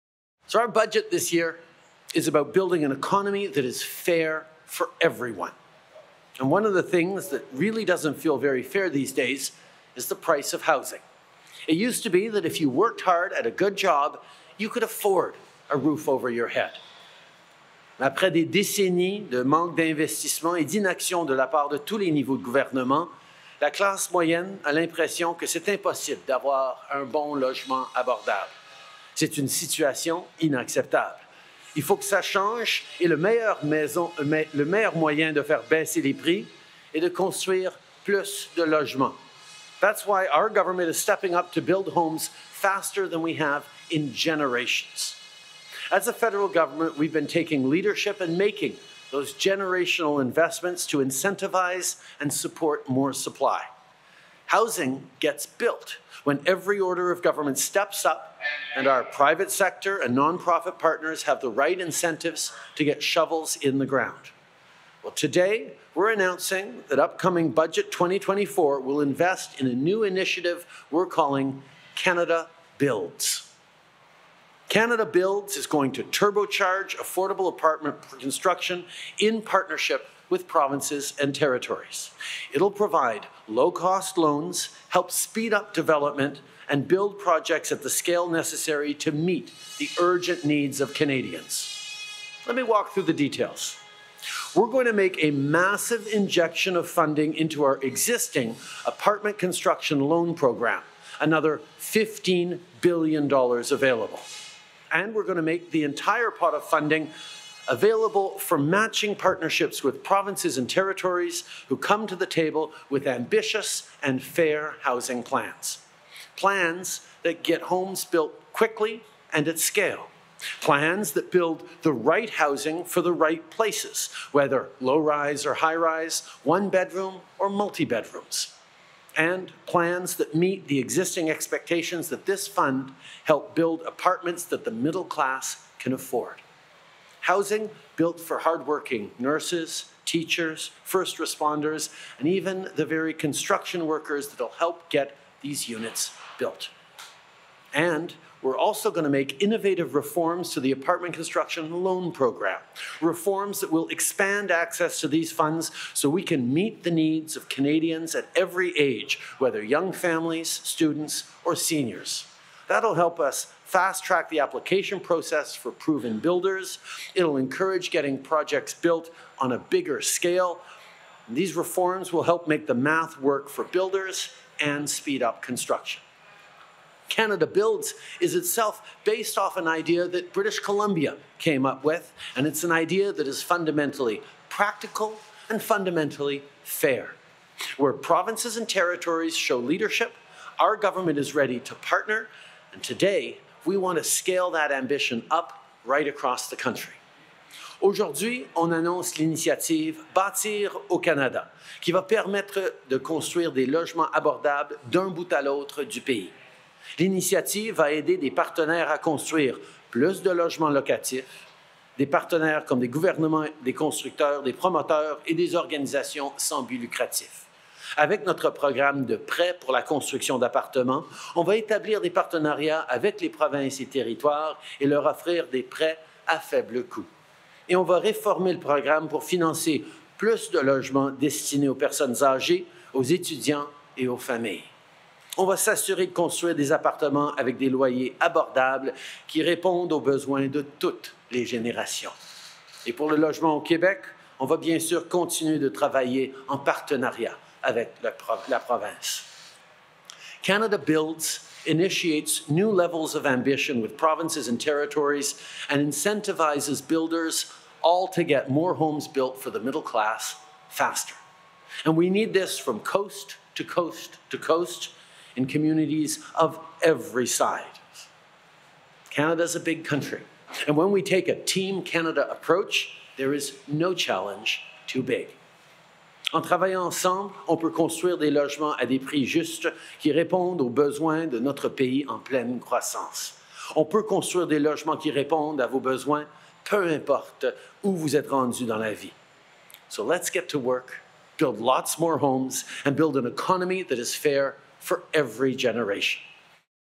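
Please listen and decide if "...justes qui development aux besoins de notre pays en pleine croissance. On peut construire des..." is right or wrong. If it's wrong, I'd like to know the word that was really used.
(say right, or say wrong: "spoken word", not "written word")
wrong: "répondent", not "development".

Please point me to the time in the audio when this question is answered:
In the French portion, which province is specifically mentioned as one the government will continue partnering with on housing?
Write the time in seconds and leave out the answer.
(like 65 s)
243 s.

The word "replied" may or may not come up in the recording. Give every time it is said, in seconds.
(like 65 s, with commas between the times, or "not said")
not said.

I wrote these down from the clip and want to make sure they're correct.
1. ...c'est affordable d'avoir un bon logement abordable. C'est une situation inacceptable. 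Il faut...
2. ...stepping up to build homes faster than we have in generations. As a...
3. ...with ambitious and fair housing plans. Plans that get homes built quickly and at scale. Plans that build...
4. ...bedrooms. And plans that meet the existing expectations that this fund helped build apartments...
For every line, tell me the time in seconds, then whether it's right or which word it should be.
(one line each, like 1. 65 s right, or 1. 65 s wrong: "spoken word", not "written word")
1. 25 s wrong: "impossible", not "affordable"
2. 40 s right
3. 112 s right
4. 127 s right.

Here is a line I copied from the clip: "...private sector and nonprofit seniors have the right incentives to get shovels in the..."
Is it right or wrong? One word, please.
wrong.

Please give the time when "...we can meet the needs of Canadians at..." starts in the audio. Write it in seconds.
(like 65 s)
156 s.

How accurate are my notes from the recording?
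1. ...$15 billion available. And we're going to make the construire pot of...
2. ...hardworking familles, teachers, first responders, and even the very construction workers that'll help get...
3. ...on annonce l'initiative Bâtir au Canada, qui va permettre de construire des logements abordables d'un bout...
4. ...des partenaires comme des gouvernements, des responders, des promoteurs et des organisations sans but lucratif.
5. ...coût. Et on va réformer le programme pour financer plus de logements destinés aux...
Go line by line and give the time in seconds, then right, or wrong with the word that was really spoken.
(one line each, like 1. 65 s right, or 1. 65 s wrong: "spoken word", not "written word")
1. 101 s wrong: "entire", not "construire"
2. 138 s wrong: "nurses", not "familles"
3. 198 s right
4. 211 s wrong: "constructeurs", not "responders"
5. 226 s right.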